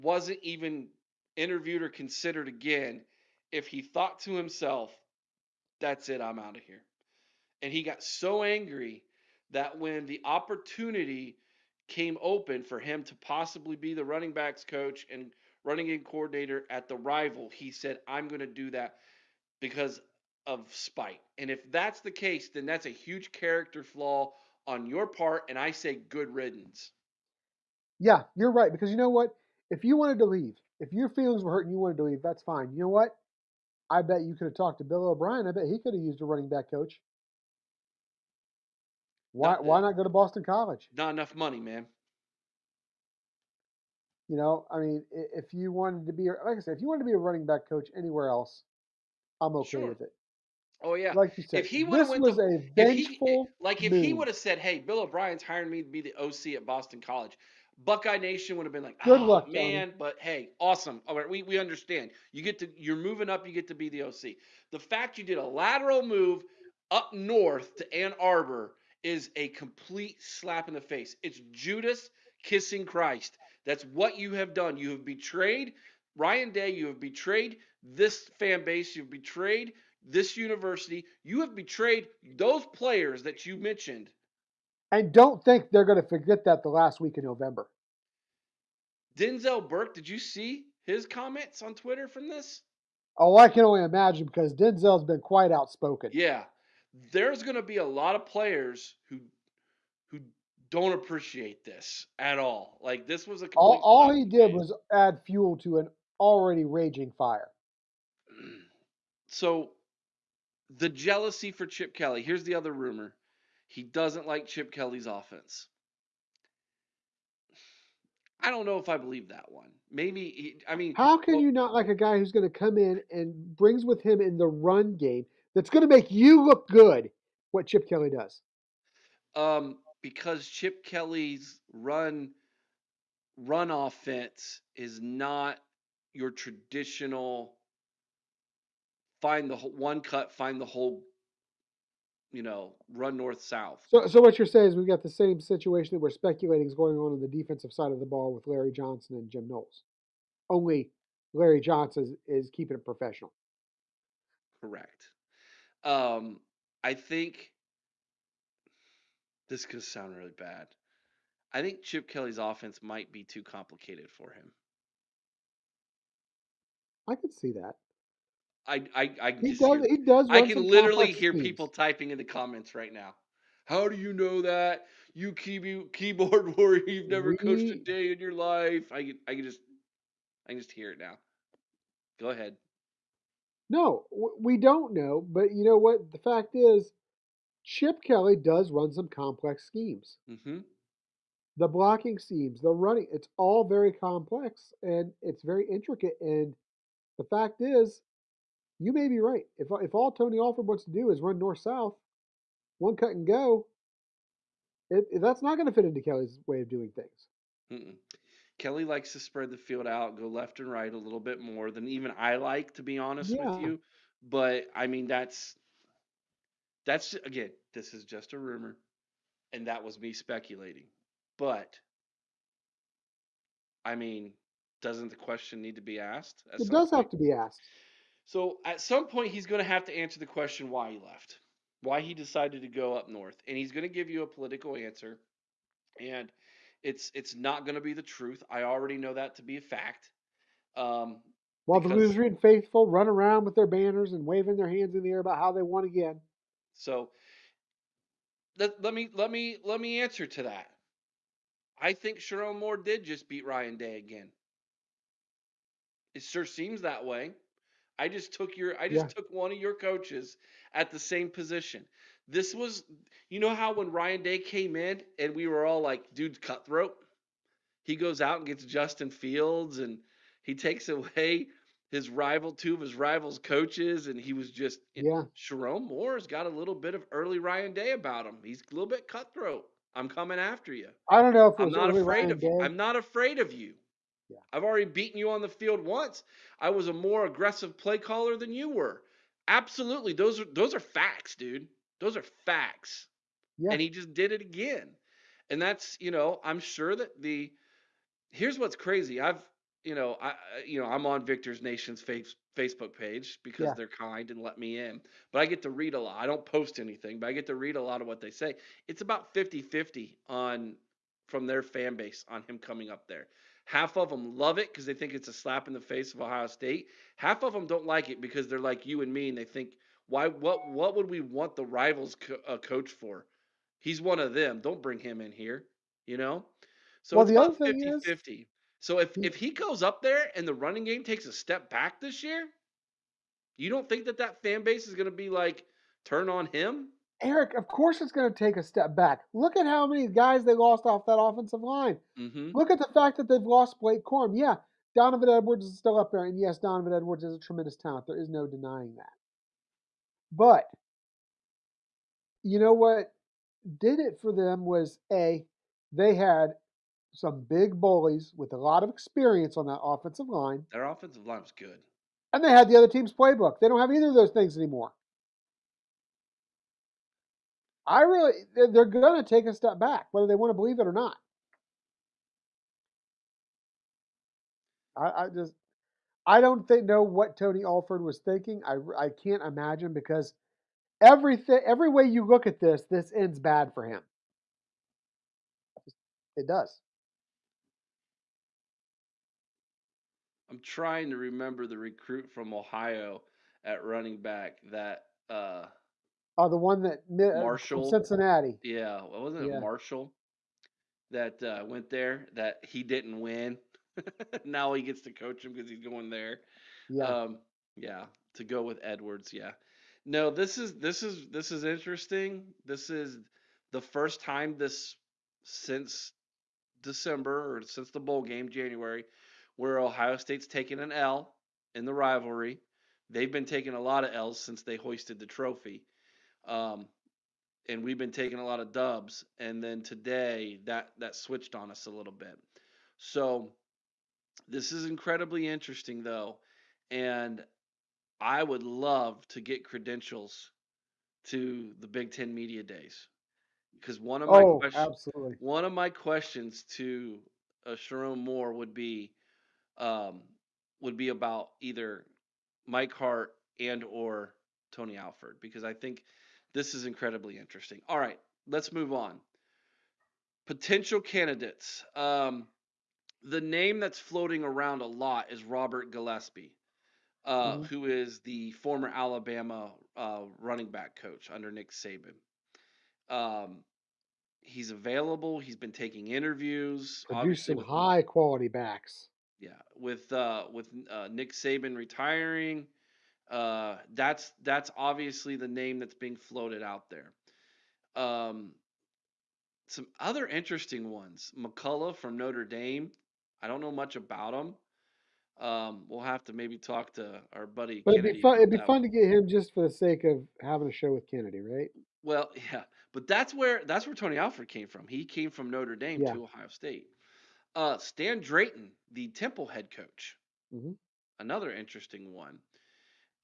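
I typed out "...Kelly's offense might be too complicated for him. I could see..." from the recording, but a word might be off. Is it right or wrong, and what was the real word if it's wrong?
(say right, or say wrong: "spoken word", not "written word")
right.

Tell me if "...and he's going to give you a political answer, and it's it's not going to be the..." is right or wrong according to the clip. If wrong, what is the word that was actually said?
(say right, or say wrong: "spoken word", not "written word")
right.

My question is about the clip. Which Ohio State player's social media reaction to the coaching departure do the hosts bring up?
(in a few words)
Denzel Burke.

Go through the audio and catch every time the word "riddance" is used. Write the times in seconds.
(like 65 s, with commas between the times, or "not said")
26 s.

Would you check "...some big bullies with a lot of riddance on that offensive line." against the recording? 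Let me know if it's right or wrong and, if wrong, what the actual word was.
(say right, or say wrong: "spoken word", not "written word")
wrong: "experience", not "riddance".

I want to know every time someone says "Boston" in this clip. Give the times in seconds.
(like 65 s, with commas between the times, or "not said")
40 s, 56 s.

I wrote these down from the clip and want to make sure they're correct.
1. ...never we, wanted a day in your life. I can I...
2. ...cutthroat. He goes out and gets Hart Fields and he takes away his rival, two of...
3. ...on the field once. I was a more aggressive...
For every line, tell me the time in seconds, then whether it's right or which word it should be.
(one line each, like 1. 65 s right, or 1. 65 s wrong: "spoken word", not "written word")
1. 177 s wrong: "coached", not "wanted"
2. 266 s wrong: "Justin", not "Hart"
3. 285 s right.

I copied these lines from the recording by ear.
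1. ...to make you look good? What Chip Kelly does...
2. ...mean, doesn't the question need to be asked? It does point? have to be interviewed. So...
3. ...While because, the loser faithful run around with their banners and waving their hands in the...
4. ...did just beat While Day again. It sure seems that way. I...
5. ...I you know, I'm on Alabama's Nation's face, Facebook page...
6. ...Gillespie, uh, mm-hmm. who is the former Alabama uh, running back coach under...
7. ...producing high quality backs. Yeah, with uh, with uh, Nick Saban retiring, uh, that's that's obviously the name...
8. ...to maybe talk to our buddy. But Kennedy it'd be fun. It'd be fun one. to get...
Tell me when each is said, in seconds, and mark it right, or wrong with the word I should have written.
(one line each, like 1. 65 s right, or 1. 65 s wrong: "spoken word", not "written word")
1. 125 s right
2. 223 s wrong: "asked", not "interviewed"
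3. 241 s right
4. 252 s wrong: "Ryan", not "While"
5. 300 s wrong: "Victor", not "Alabama"
6. 465 s right
7. 477 s right
8. 496 s right.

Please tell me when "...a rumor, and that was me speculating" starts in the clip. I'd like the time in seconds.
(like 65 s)
218 s.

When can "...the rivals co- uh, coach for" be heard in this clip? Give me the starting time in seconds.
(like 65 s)
321 s.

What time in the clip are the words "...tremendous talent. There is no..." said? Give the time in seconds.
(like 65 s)
347 s.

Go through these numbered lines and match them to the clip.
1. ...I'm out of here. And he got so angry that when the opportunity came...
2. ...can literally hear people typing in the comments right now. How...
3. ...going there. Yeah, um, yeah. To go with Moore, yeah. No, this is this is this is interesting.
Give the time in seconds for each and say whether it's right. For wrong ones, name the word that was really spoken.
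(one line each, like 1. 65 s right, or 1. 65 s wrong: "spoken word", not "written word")
1. 6 s right
2. 170 s right
3. 405 s wrong: "Edwards", not "Moore".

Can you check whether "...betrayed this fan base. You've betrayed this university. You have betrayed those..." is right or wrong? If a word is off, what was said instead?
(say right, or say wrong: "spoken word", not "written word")
right.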